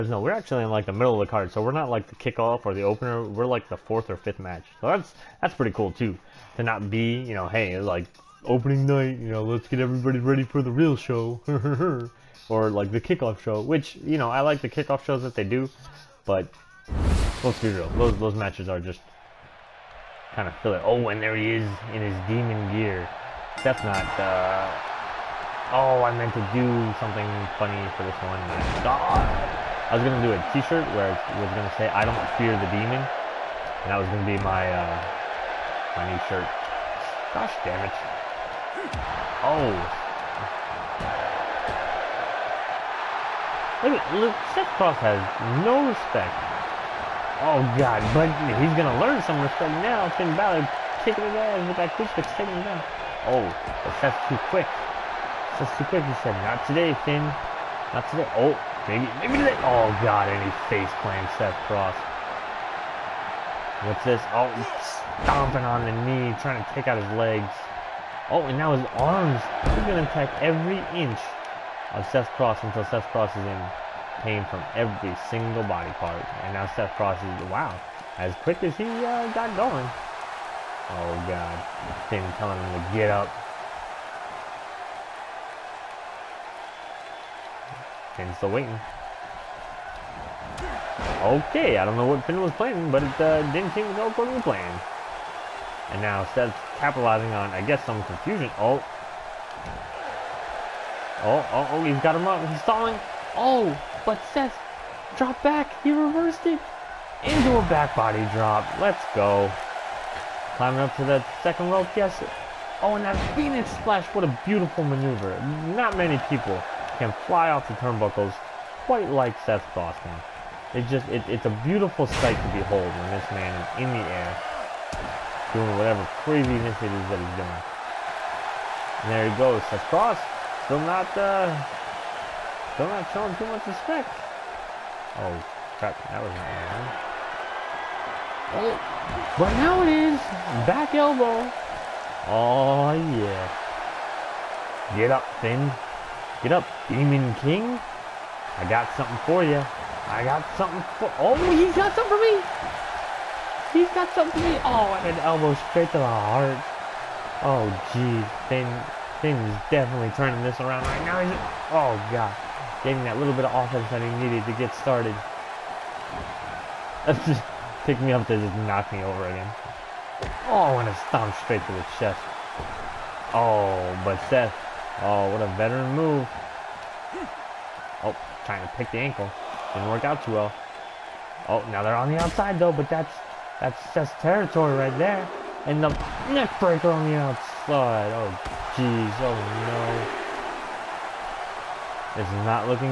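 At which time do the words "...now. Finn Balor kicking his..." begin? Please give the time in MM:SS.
00:49.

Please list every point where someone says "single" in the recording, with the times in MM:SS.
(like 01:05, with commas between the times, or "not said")
01:15.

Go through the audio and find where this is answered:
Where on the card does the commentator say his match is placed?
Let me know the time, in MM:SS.
00:03.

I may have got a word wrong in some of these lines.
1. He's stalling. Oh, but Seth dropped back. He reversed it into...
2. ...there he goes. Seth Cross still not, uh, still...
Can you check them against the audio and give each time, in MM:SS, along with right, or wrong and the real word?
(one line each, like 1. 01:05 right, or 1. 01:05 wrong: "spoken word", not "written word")
1. 01:42 right
2. 02:09 right.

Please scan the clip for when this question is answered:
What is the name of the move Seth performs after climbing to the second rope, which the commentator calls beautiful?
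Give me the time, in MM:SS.
01:53.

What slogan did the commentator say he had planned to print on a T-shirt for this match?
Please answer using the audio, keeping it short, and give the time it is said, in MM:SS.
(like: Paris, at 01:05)
I don't fear the demon, at 00:31.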